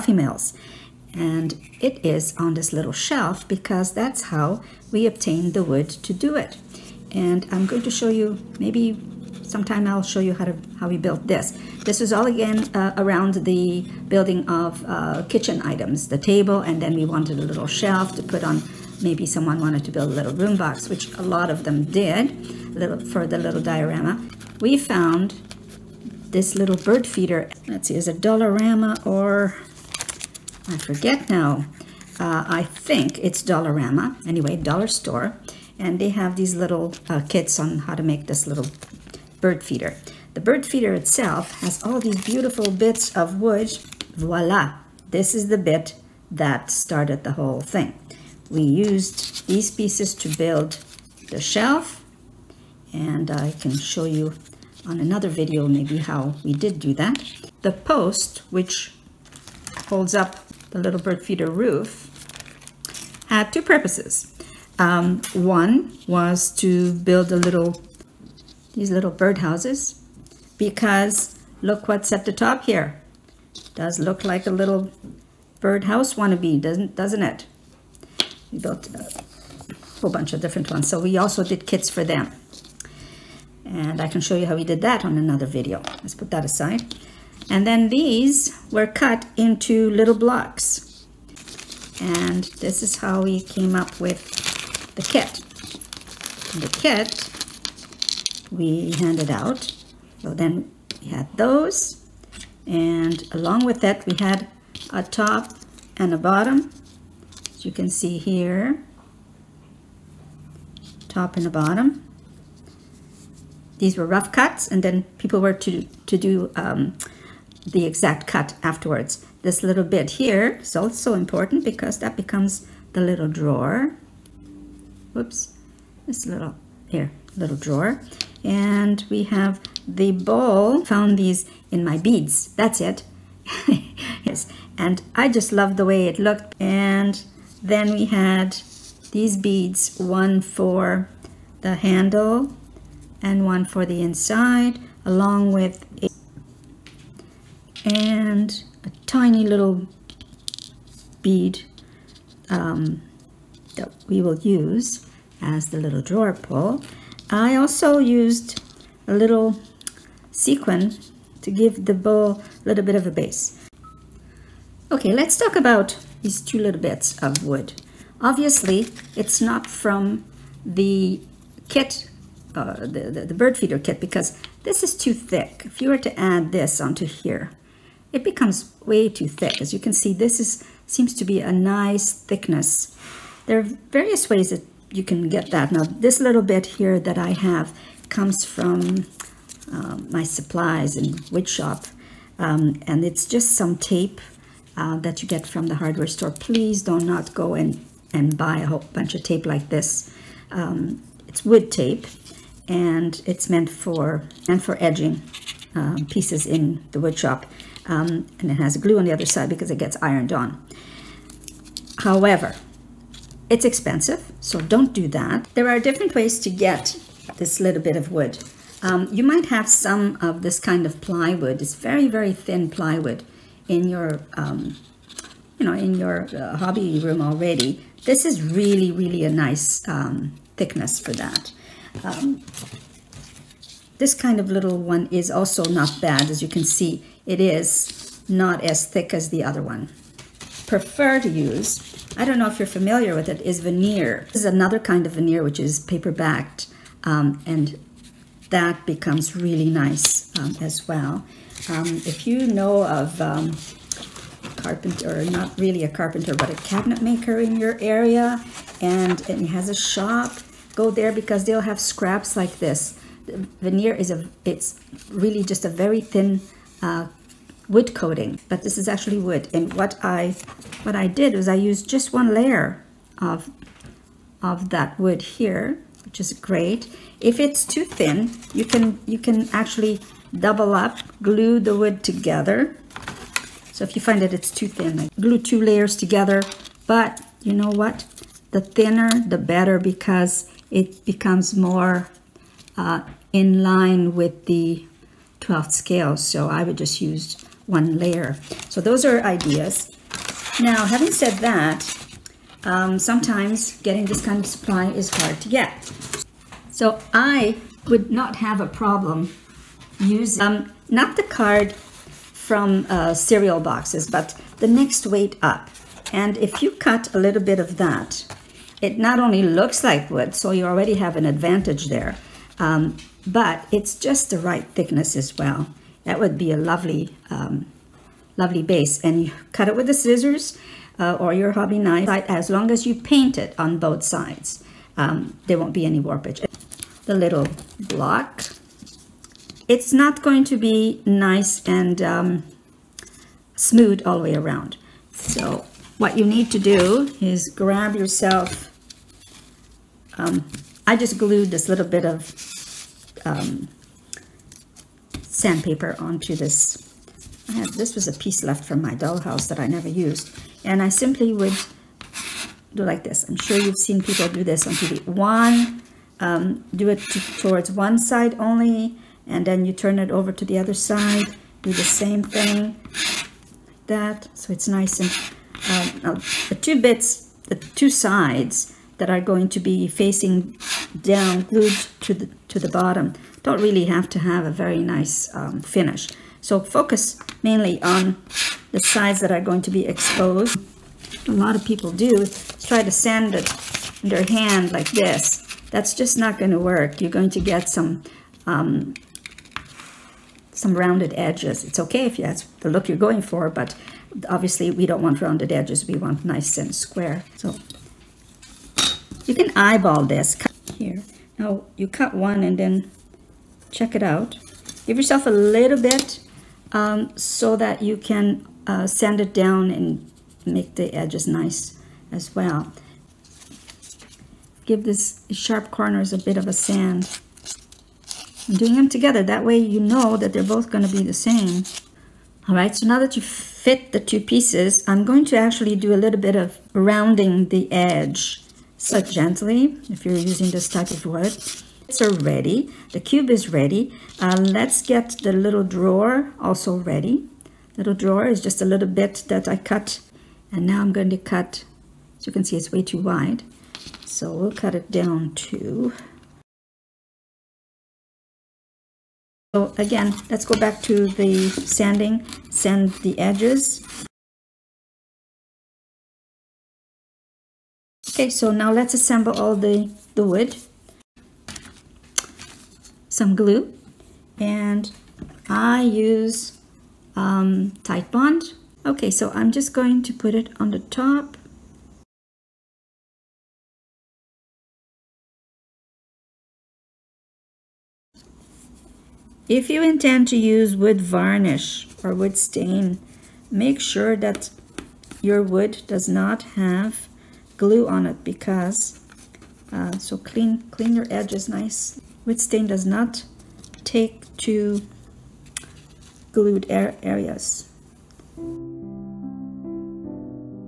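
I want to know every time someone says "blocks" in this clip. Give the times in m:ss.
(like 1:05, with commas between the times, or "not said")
1:30, 5:37.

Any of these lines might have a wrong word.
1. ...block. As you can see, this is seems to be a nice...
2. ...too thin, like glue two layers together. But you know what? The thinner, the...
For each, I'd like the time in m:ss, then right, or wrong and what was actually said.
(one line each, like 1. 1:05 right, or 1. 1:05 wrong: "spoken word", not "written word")
1. 2:59 wrong: "thick", not "block"
2. 4:44 right.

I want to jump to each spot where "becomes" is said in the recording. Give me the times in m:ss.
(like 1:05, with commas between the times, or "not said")
2:02, 2:58, 4:08, 4:51.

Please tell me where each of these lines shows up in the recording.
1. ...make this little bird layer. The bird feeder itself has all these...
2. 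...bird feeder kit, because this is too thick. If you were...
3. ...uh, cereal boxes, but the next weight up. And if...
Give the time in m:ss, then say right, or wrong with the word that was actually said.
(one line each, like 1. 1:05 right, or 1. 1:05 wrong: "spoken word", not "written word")
1. 0:38 wrong: "feeder", not "layer"
2. 2:53 right
3. 5:12 right.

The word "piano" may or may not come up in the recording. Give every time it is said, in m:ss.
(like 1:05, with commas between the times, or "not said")
not said.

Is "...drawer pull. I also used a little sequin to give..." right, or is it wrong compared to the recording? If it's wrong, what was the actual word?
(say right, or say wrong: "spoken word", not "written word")
right.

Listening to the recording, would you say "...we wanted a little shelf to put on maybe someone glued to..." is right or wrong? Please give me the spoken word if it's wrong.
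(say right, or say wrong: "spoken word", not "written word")
wrong: "wanted", not "glued".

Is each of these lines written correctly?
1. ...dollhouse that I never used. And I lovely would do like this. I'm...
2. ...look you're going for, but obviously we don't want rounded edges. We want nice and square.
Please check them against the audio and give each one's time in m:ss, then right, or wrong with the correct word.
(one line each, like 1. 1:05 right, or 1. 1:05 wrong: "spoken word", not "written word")
1. 5:58 wrong: "simply", not "lovely"
2. 6:42 right.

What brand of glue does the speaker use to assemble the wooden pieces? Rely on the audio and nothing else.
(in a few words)
Titebond.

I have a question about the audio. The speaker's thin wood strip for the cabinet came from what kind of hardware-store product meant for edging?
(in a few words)
wood tape.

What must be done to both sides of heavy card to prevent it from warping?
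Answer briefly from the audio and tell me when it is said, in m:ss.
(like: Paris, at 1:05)
paint it, at 5:32.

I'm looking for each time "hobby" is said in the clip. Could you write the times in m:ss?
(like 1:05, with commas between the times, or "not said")
3:46, 5:31.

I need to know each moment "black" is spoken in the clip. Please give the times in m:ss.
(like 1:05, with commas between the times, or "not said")
not said.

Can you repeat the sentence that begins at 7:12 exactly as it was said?
All right, so now that you fit the two pieces, I'm going to actually do a little bit of rounding the edge.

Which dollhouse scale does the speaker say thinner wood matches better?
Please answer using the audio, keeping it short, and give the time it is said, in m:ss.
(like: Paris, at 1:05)
12th scale, at 4:55.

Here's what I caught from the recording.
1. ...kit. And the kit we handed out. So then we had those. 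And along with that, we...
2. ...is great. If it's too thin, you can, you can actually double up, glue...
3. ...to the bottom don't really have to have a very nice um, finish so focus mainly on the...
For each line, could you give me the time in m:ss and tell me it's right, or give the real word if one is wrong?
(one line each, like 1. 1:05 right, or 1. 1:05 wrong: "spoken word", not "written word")
1. 1:35 right
2. 4:36 right
3. 6:22 right.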